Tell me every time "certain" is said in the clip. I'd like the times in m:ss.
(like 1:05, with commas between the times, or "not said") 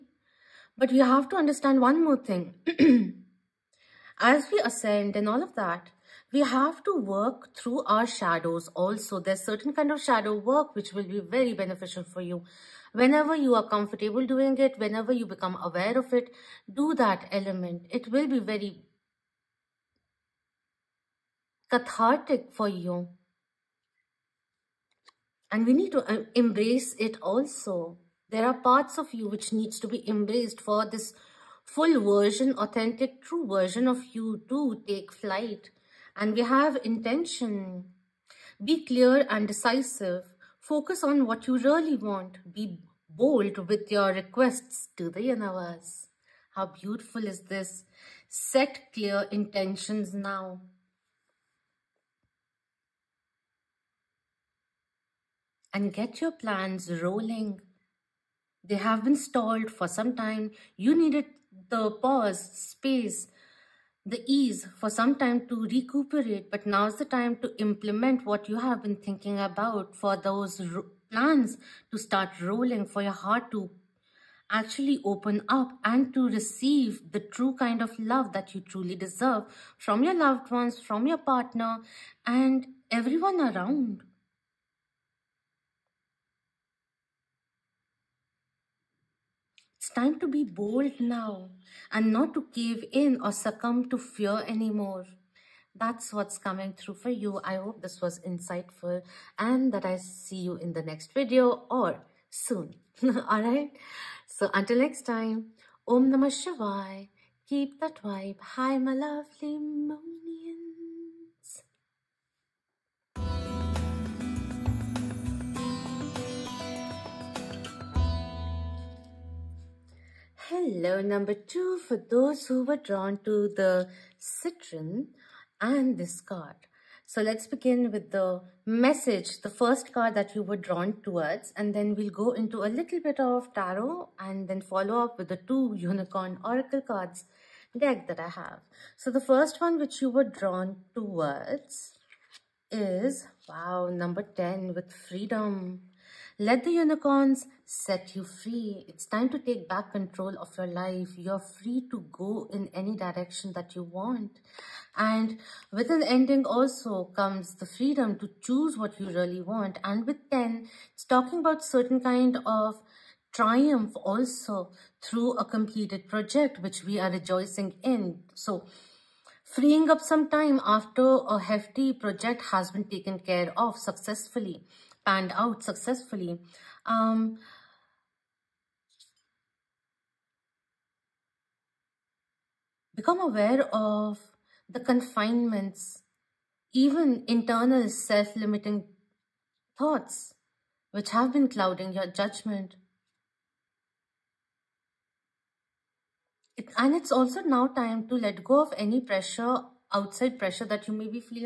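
0:09, 2:41.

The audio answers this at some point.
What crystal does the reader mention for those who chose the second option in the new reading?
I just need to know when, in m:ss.
2:04.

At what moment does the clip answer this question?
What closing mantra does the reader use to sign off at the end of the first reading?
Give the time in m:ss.
1:45.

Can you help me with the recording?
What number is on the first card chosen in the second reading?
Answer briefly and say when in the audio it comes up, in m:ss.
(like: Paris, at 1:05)
10, at 2:23.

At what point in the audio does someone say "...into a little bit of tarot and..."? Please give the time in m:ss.
2:12.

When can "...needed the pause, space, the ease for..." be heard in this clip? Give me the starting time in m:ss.
1:00.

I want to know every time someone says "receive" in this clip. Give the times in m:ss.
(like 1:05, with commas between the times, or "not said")
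1:16.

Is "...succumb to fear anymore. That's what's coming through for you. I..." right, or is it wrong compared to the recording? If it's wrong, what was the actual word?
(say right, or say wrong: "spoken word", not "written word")
right.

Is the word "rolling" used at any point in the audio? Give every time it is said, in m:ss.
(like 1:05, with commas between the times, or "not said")
0:57, 1:12.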